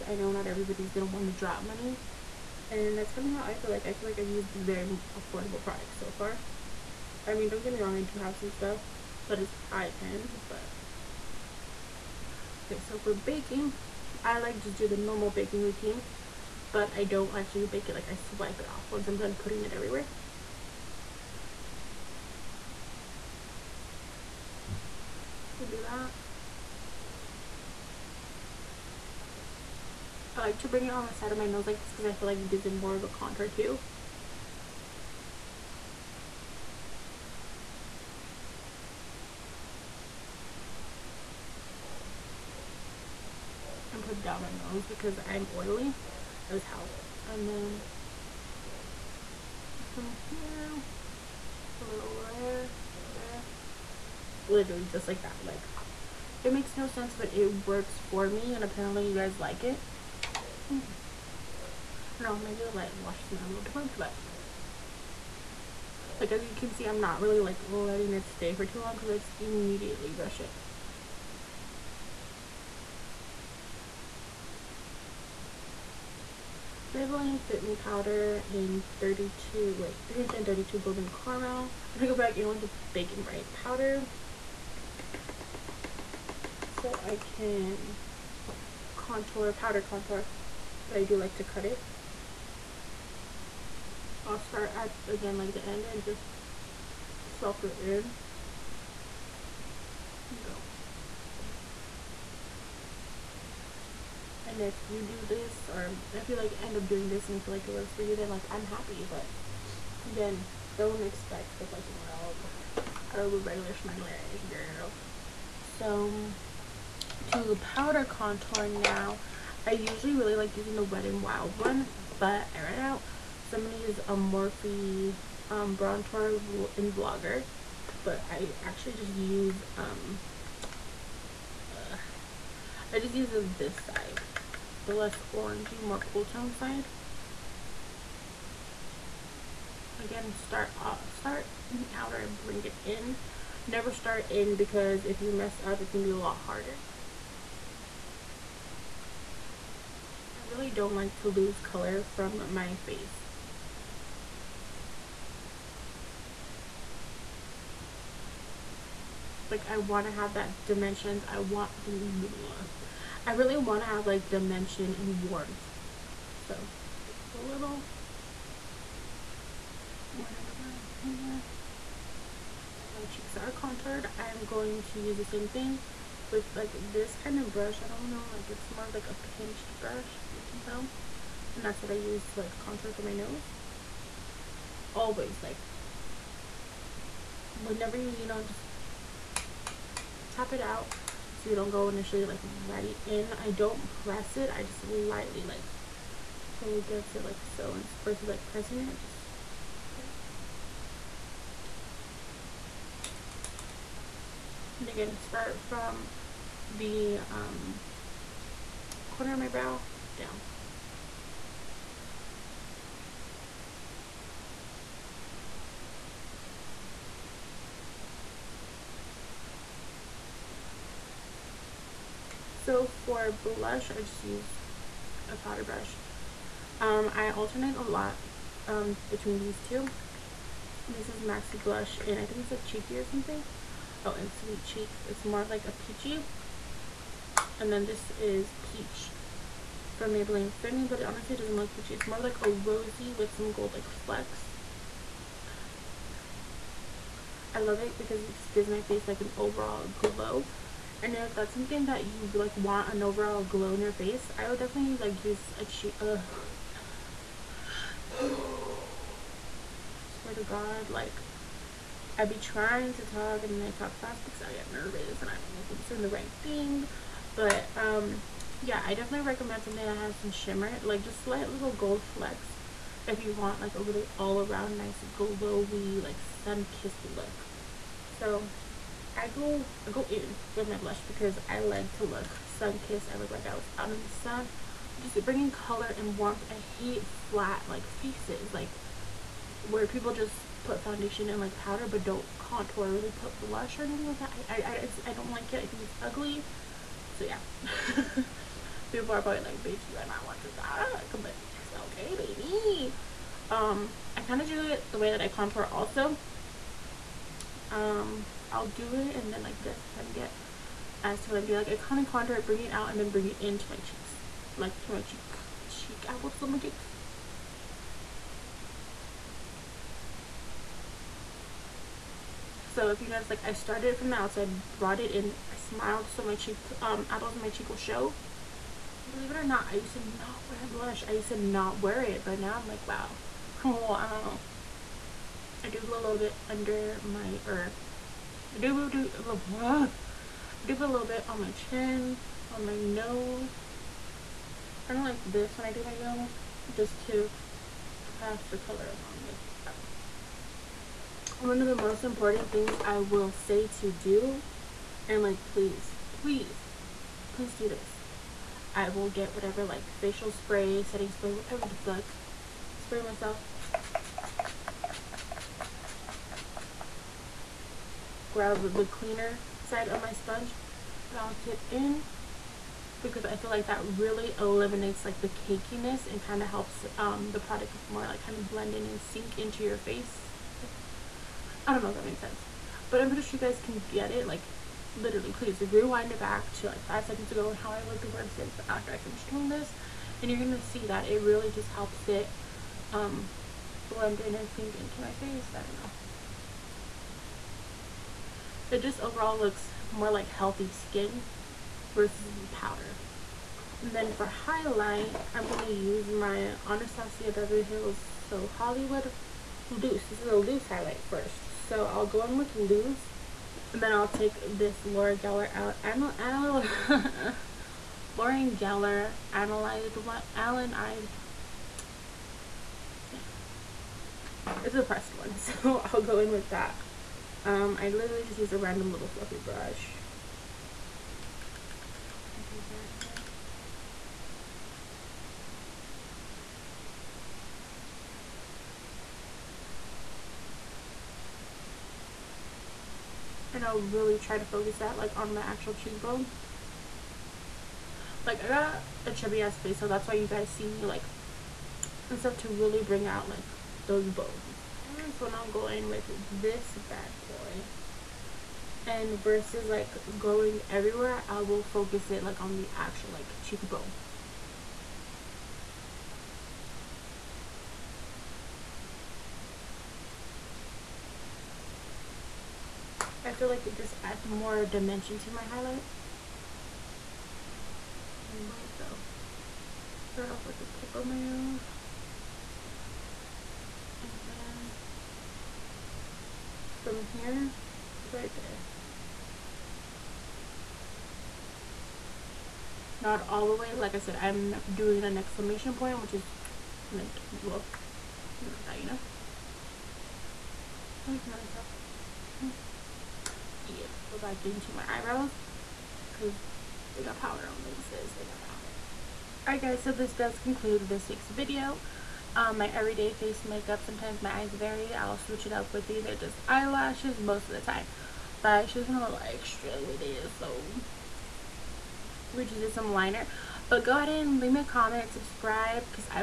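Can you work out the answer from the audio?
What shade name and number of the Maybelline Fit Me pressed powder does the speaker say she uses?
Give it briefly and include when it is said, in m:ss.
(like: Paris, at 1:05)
332 Golden Caramel, at 1:20.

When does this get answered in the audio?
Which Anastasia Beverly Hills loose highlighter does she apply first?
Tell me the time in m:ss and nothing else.
6:48.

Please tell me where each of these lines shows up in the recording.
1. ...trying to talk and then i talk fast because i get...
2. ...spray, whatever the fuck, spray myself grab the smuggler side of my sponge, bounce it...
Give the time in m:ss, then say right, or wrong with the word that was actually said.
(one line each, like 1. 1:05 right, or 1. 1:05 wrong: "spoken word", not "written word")
1. 4:22 right
2. 6:01 wrong: "cleaner", not "smuggler".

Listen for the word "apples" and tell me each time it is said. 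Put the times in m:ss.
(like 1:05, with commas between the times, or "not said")
5:16, 5:27.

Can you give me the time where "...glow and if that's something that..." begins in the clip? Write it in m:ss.
4:09.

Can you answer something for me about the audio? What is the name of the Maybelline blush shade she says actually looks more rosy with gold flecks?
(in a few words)
Peach.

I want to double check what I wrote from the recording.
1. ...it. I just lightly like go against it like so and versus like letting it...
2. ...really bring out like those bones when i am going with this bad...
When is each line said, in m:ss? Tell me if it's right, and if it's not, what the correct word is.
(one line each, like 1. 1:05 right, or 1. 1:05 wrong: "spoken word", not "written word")
1. 3:14 wrong: "pressing", not "letting"
2. 7:32 right.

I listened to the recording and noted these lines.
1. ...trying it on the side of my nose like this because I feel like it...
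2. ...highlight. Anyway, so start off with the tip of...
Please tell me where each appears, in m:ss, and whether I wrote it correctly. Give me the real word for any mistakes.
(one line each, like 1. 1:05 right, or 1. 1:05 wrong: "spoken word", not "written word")
1. 0:30 wrong: "bring", not "trying"
2. 7:55 right.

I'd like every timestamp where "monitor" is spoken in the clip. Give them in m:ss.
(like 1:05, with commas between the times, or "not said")
not said.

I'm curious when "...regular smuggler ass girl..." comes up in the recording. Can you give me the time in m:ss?
1:53.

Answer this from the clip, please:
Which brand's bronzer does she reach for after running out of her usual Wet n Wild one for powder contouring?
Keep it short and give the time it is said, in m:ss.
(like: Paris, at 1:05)
Morphe, at 2:04.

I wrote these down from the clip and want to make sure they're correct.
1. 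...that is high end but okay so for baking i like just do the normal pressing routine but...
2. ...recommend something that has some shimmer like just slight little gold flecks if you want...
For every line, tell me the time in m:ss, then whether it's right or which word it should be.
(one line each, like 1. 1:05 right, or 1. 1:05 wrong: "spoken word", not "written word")
1. 0:09 wrong: "baking", not "pressing"
2. 4:29 right.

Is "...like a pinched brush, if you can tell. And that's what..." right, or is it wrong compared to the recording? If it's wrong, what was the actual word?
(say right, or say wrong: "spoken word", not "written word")
right.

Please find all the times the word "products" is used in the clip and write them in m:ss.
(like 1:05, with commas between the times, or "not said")
0:05, 6:17.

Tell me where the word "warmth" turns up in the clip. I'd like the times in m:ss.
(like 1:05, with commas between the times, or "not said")
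2:45, 4:46.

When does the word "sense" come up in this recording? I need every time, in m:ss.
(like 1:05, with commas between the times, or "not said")
0:56, 6:22.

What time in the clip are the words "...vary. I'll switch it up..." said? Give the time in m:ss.
8:34.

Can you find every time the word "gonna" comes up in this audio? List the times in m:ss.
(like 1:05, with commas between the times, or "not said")
0:00, 1:21, 2:03, 2:25, 6:30.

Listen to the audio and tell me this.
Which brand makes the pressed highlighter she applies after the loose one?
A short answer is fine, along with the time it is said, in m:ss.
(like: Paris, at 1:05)
Laura Geller, at 6:54.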